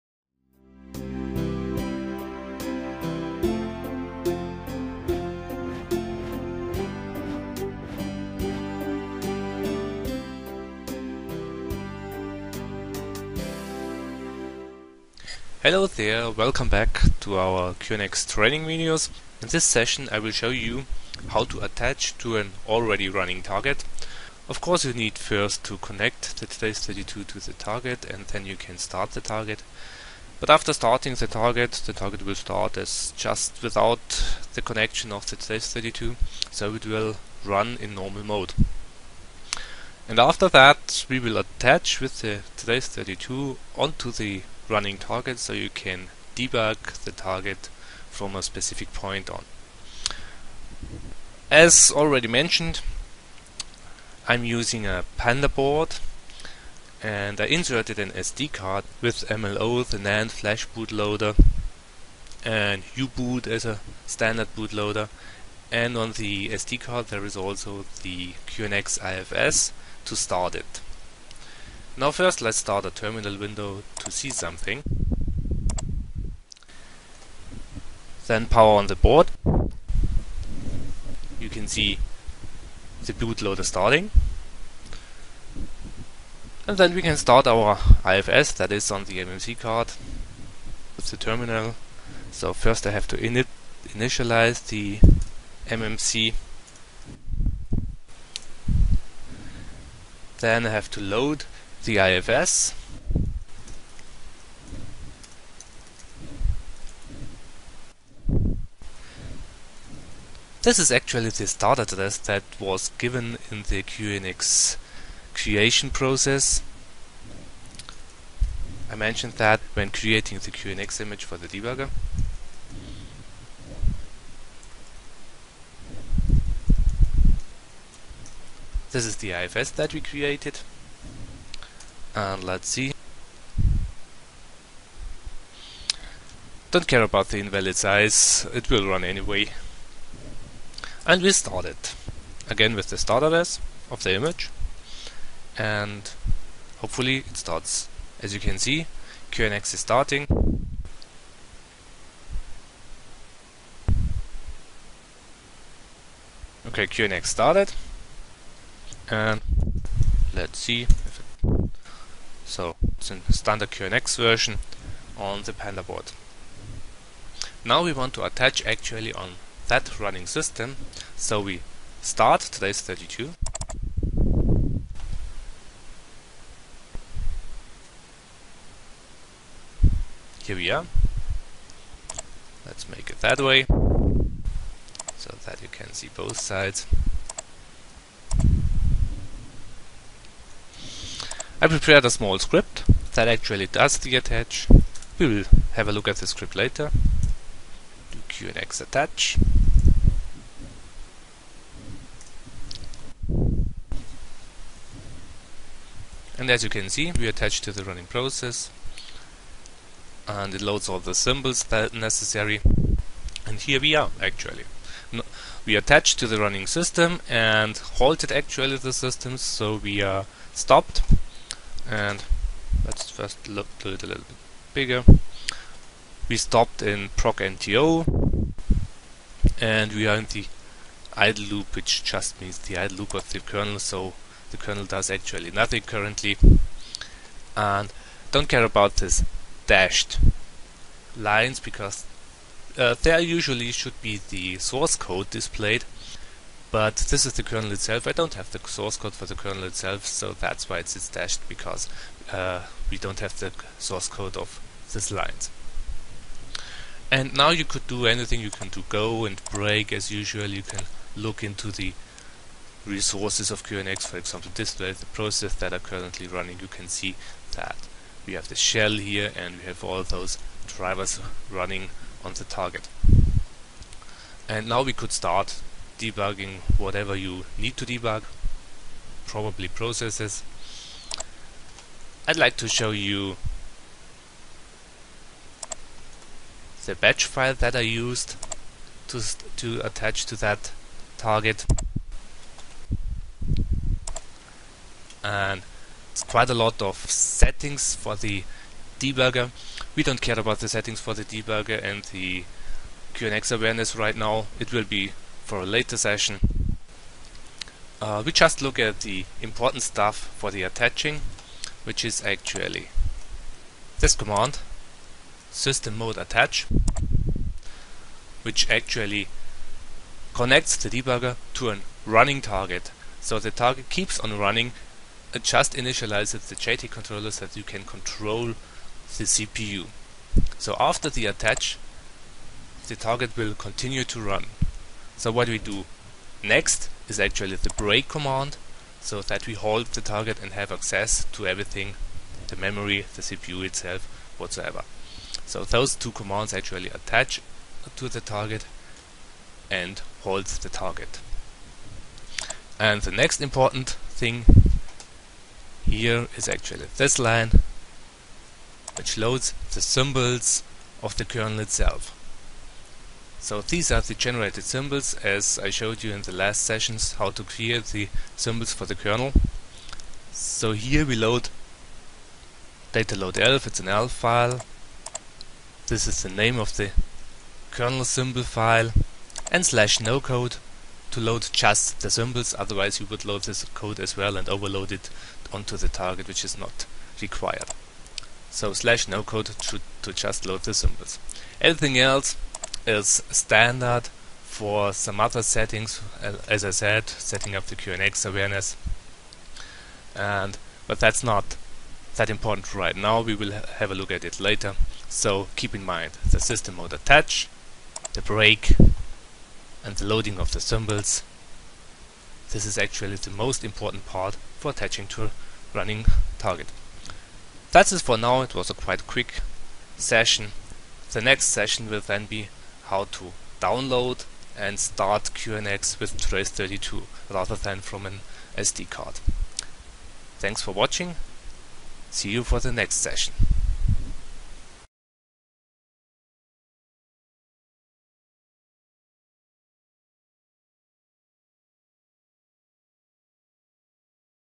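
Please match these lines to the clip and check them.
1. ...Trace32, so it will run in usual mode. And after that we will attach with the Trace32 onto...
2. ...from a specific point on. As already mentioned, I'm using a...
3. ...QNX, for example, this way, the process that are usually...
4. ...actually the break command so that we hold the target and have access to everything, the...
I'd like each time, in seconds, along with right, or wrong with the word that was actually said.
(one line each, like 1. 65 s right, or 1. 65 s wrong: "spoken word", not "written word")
1. 35 s wrong: "normal", not "usual"
2. 48 s right
3. 263 s wrong: "currently", not "usually"
4. 337 s right.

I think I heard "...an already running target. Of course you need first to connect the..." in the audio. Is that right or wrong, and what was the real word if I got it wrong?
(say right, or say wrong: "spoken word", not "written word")
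right.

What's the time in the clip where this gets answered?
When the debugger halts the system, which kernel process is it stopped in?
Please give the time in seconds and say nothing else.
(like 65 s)
227 s.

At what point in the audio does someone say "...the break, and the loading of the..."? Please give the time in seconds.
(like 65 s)
408 s.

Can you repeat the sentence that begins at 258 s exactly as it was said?
You can do go and break as usual.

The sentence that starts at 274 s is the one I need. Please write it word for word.
And now we could start debugging whatever you need to debug, probably processes.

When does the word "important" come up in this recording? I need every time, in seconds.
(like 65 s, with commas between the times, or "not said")
309 s, 353 s, 402 s, 413 s.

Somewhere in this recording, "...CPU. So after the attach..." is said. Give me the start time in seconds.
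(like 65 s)
329 s.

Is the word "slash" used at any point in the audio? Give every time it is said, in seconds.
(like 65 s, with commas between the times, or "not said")
379 s, 388 s.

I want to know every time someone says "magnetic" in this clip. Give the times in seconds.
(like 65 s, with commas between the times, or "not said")
not said.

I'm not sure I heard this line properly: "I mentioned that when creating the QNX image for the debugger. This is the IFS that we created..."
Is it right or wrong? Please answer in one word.
right.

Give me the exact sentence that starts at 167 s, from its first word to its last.
Now we want to attach actually on that running system.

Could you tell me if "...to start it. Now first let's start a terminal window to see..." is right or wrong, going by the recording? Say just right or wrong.
right.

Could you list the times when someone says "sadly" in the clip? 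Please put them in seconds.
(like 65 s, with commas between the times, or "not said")
not said.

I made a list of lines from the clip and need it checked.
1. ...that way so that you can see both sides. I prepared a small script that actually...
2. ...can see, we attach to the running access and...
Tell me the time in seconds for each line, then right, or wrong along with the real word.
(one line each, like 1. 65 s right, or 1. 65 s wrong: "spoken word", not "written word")
1. 183 s right
2. 206 s wrong: "process", not "access".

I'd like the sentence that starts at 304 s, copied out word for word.
It will be for a later session.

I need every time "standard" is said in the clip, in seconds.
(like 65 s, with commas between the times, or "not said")
64 s, 163 s, 393 s.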